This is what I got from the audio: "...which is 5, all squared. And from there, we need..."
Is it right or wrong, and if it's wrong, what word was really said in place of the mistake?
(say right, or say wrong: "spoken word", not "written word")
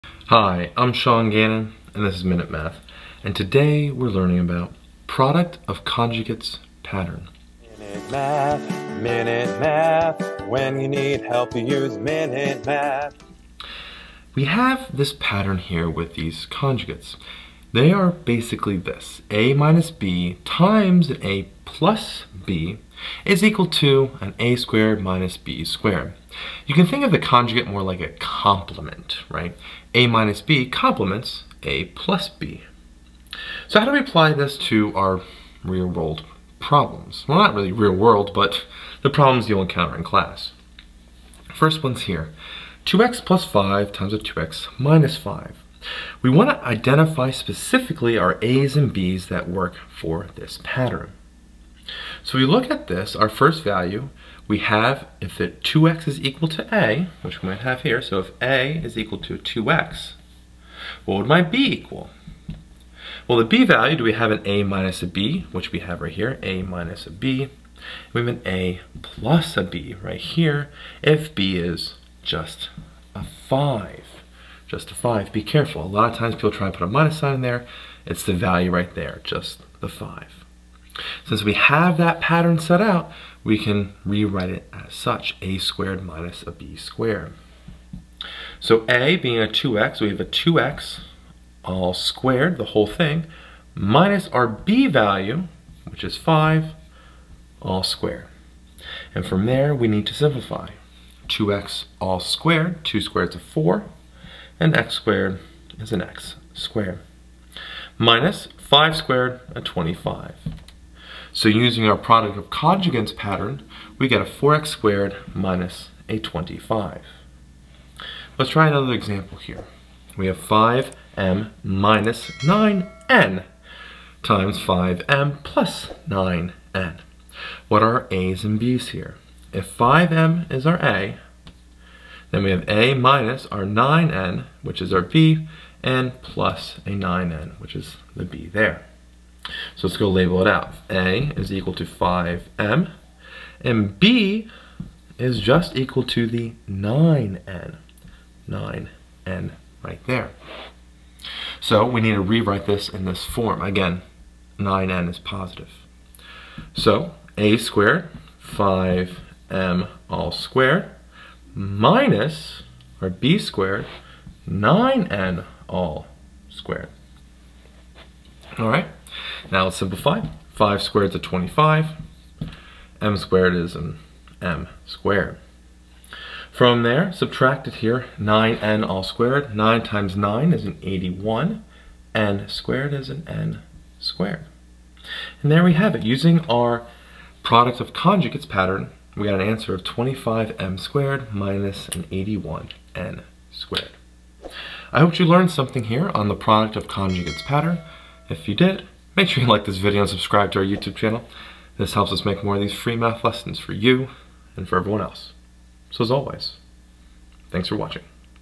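right.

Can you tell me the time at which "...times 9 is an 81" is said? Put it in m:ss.
2:59.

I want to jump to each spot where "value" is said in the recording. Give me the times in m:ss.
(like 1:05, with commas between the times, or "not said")
0:53, 1:03, 1:18, 1:34.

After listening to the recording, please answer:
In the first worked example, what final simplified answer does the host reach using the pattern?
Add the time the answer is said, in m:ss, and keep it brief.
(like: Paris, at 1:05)
4x squared minus 25, at 1:54.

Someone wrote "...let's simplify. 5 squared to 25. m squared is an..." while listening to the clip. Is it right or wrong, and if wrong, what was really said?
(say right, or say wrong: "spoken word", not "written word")
right.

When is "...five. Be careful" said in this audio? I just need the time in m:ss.
1:14.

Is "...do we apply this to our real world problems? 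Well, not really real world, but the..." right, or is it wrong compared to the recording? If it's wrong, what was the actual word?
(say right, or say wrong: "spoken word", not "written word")
right.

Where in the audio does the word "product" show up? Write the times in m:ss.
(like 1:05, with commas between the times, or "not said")
0:05, 1:51, 3:07, 3:16.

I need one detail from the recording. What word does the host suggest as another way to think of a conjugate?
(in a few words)
complement.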